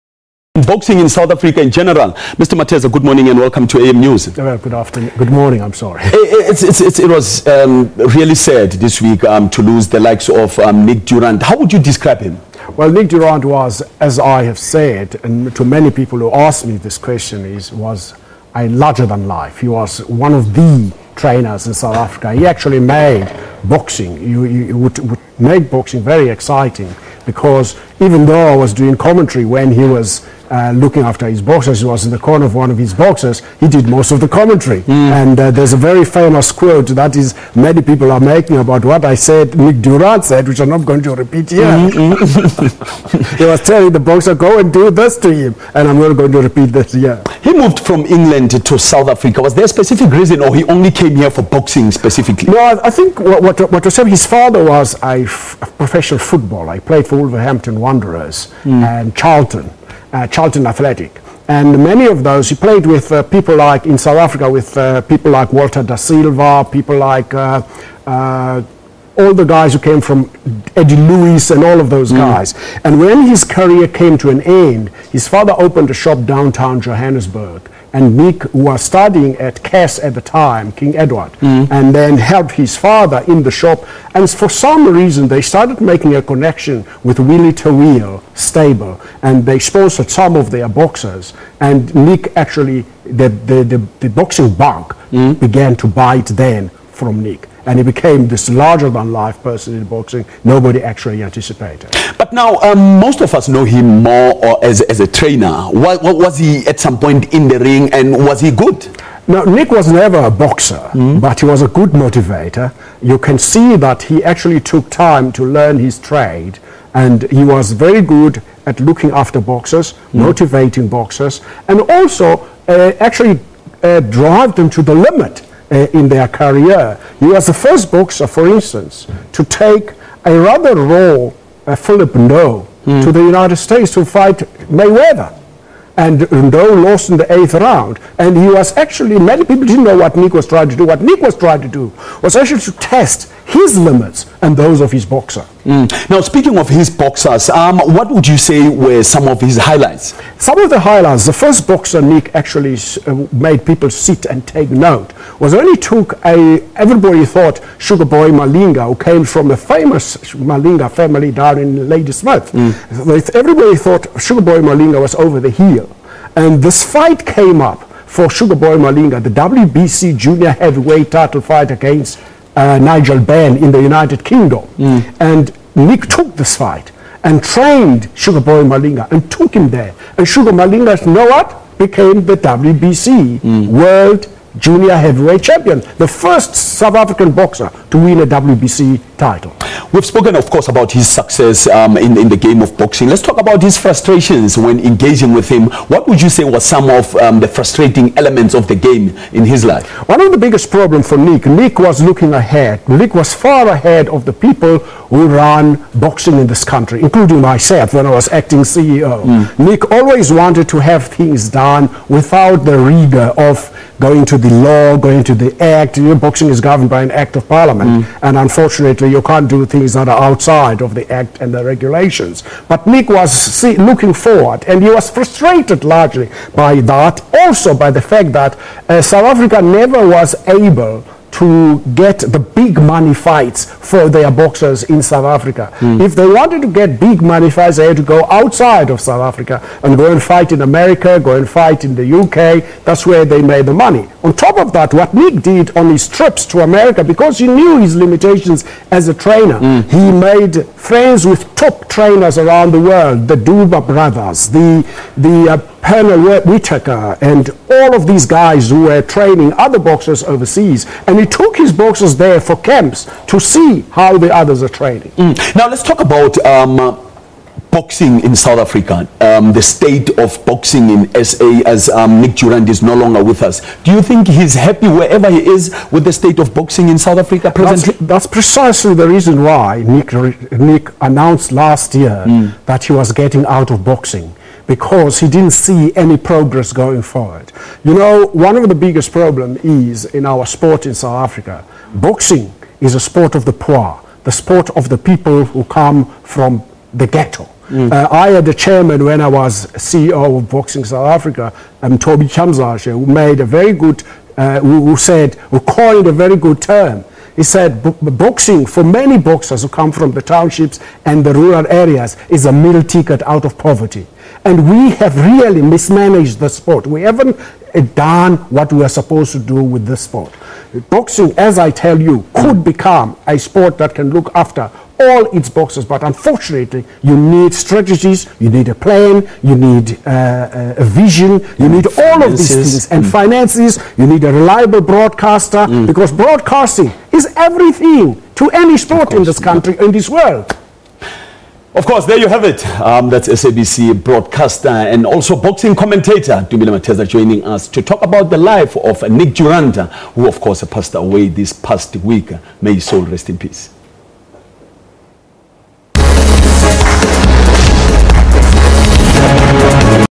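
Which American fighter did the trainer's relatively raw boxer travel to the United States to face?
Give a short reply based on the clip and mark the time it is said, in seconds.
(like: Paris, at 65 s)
Mayweather, at 134 s.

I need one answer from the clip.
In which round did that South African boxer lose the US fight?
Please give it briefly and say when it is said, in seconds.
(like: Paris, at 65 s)
8th, at 137 s.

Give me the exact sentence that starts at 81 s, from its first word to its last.
and then helped his father in the shop.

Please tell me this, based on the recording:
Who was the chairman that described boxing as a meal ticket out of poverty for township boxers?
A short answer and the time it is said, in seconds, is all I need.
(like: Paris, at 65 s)
Toby Chamzashe, at 301 s.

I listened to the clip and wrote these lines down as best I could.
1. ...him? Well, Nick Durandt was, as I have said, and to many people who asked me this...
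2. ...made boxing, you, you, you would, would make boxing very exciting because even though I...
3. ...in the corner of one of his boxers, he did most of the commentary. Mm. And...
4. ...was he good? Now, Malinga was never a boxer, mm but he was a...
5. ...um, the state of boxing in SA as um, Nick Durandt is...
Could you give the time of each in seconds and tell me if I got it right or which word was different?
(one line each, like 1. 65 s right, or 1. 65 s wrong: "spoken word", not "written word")
1. 12 s right
2. 22 s right
3. 32 s right
4. 108 s wrong: "Nick", not "Malinga"
5. 269 s right.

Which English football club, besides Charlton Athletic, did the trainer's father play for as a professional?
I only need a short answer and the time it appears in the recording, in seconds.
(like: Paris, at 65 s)
Wolverhampton Wanderers, at 57 s.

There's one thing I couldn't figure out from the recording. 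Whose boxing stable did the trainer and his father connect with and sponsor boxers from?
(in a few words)
Willie Toweel.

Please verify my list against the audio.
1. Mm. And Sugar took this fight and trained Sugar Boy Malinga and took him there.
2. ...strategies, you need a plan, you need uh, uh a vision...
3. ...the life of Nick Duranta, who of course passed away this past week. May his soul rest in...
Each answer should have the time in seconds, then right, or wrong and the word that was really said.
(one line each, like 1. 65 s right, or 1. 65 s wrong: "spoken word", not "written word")
1. 174 s wrong: "Nick", not "Sugar"
2. 327 s right
3. 348 s right.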